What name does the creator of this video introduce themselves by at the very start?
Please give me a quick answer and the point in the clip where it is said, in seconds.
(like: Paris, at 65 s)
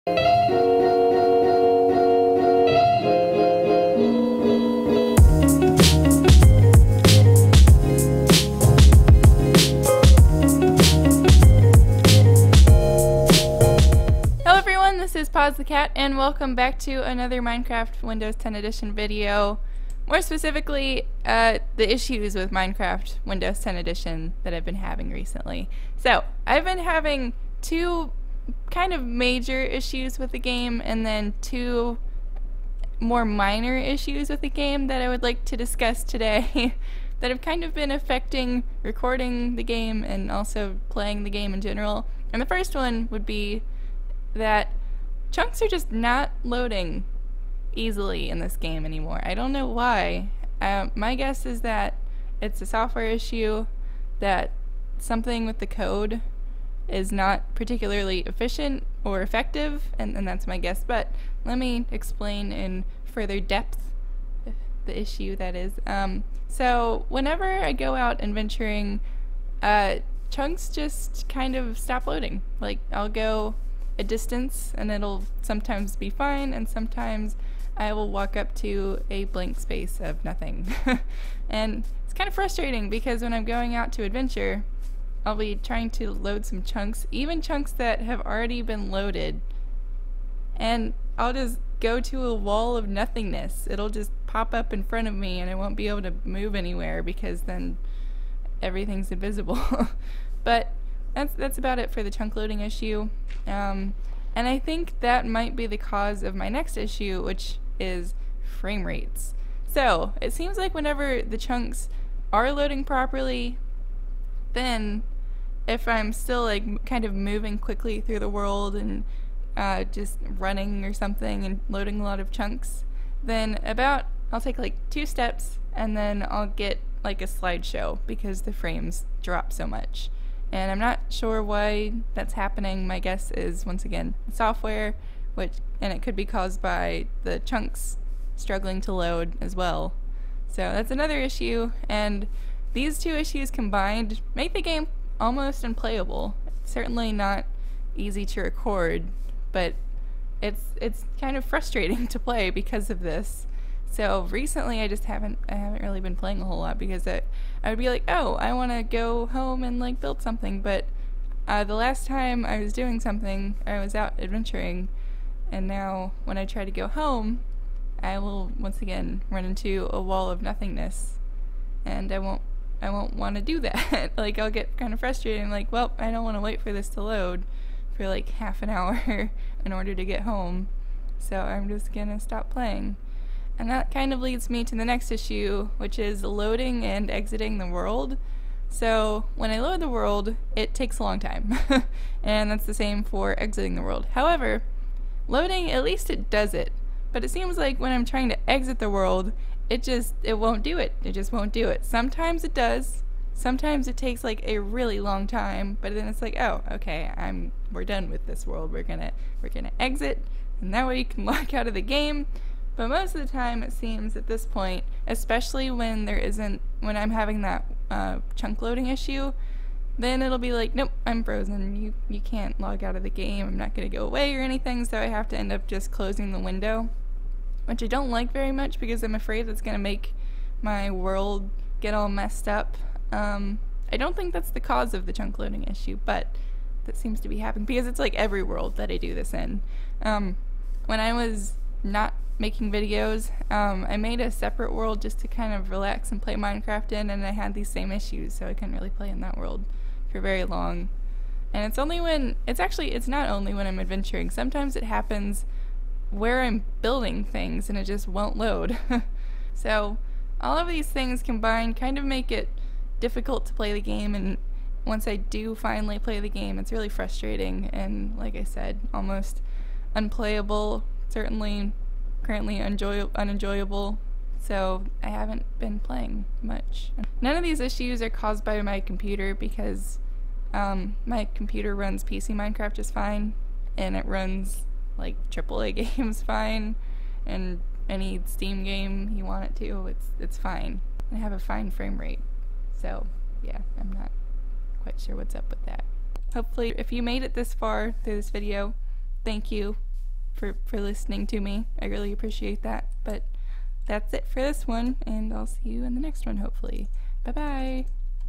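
Pause the Cat, at 15 s.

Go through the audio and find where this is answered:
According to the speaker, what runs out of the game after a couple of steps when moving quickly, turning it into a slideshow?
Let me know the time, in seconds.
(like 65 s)
108 s.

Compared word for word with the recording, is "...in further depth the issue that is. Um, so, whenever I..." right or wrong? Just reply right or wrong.
right.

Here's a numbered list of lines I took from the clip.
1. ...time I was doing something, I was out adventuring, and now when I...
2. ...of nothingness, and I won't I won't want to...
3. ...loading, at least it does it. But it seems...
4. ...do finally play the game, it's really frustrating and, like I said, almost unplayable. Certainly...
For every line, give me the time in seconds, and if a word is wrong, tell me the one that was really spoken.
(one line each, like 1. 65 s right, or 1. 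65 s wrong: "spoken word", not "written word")
1. 162 s right
2. 170 s right
3. 195 s right
4. 265 s right.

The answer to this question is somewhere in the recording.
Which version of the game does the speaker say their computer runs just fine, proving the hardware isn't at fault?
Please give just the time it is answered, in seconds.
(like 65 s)
282 s.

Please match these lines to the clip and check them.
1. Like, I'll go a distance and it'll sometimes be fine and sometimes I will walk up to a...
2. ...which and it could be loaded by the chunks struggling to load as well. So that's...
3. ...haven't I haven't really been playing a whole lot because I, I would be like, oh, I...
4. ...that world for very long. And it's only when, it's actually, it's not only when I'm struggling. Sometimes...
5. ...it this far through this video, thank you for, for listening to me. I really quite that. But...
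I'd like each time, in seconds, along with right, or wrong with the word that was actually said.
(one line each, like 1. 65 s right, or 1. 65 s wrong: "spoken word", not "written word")
1. 72 s right
2. 135 s wrong: "caused", not "loaded"
3. 155 s right
4. 249 s wrong: "adventuring", not "struggling"
5. 297 s wrong: "appreciate", not "quite".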